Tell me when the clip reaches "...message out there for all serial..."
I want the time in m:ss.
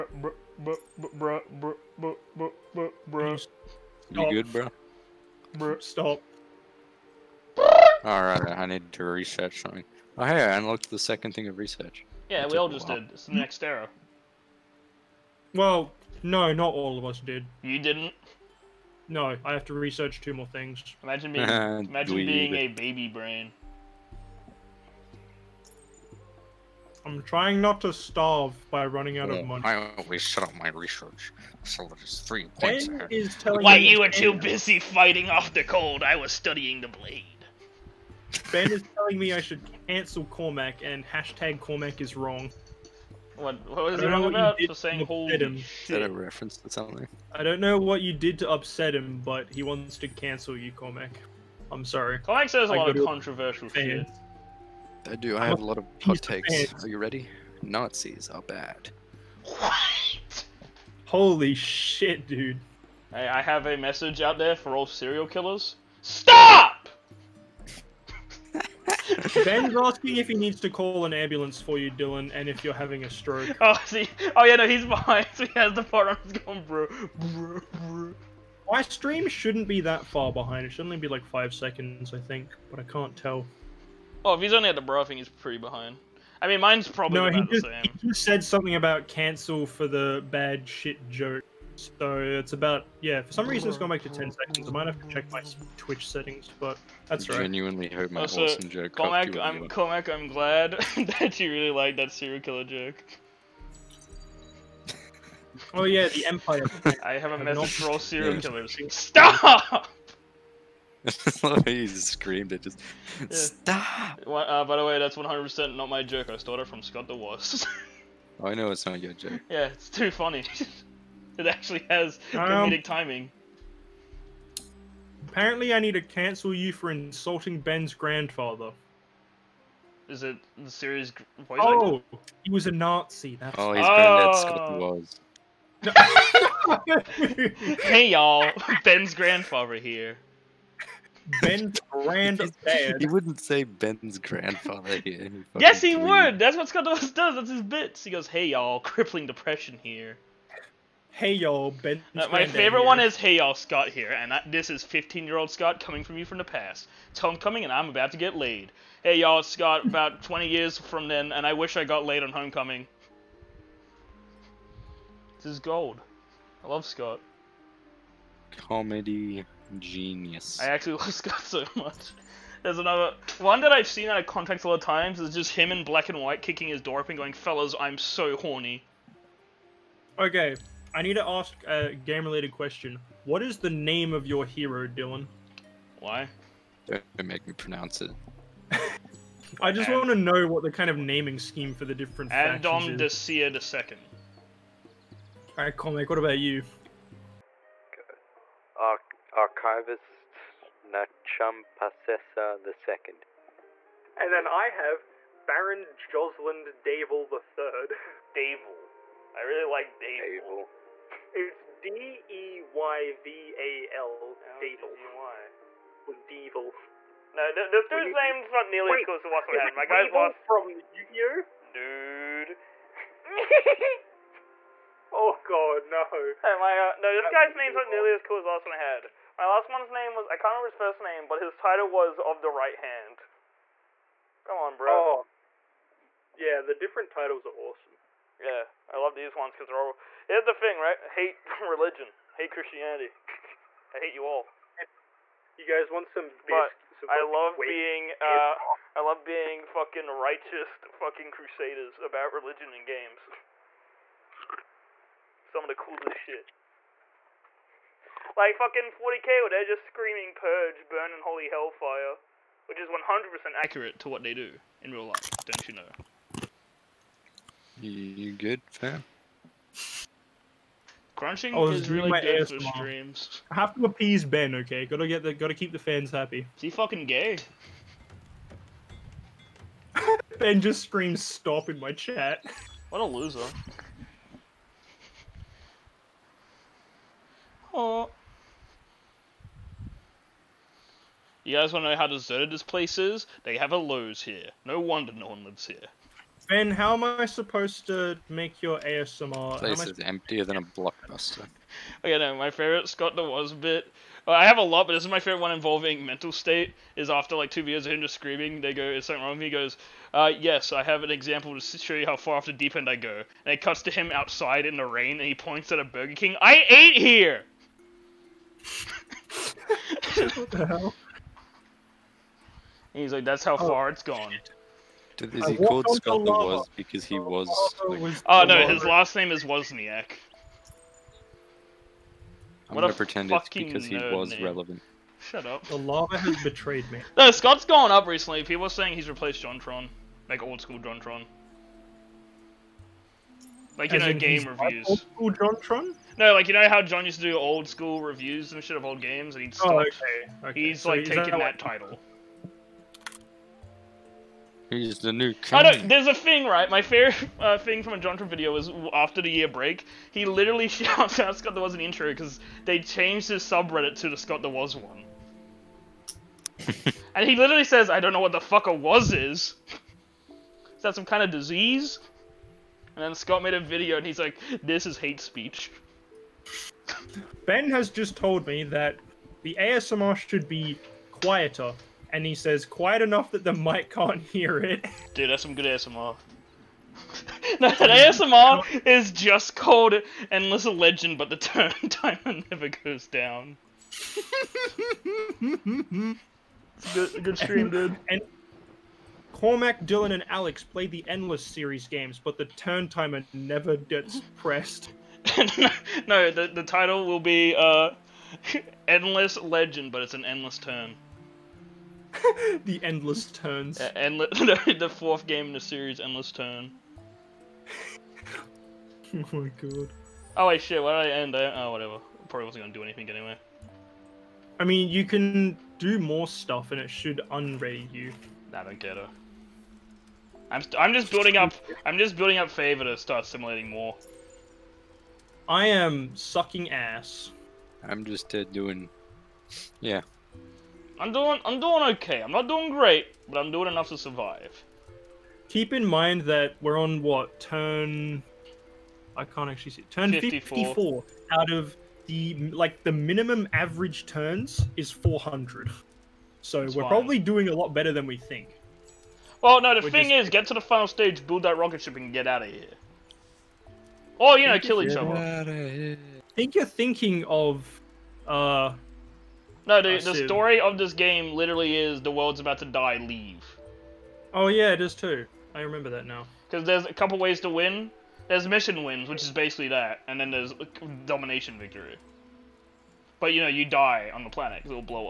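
1:03.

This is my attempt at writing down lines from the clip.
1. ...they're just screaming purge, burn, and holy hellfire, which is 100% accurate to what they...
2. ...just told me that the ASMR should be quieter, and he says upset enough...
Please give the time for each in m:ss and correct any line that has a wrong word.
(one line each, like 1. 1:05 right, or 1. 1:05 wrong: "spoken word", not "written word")
1. 4:19 right
2. 6:17 wrong: "quiet", not "upset".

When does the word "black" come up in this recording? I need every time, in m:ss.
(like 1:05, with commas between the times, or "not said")
2:55.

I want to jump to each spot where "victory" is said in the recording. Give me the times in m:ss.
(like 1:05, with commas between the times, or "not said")
8:01.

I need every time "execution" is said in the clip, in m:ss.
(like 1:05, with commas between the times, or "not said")
not said.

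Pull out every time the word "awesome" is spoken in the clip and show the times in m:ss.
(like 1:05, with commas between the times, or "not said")
1:38, 3:57.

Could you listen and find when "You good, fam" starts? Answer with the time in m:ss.
4:27.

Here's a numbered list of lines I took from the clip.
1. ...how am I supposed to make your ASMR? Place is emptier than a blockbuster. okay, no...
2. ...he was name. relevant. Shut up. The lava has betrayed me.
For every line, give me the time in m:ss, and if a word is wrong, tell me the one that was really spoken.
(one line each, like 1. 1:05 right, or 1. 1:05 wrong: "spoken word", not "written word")
1. 4:56 right
2. 5:33 right.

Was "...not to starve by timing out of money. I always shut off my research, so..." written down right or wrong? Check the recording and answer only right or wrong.
wrong.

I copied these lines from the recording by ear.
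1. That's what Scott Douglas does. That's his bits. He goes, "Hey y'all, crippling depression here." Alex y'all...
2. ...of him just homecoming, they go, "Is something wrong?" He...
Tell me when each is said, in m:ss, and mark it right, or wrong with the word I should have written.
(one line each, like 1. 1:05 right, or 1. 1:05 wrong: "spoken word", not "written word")
1. 2:26 wrong: "Hey", not "Alex"
2. 5:07 wrong: "screaming", not "homecoming".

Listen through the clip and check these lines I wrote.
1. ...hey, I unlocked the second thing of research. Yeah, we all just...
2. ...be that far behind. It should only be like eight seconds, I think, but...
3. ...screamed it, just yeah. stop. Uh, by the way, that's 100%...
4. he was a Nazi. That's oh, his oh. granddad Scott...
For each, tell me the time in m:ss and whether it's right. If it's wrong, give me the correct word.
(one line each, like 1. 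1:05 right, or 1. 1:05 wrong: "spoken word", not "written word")
1. 0:10 right
2. 1:19 wrong: "five", not "eight"
3. 1:52 right
4. 2:12 right.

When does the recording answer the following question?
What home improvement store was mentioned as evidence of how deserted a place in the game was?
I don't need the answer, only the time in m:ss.
4:53.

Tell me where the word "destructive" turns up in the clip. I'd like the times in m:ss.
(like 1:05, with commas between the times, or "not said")
not said.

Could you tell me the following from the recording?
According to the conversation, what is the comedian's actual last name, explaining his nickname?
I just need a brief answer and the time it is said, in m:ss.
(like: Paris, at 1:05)
Wozniak, at 5:28.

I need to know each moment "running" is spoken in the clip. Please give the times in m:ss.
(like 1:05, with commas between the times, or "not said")
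0:28.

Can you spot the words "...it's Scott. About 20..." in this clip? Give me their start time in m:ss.
2:39.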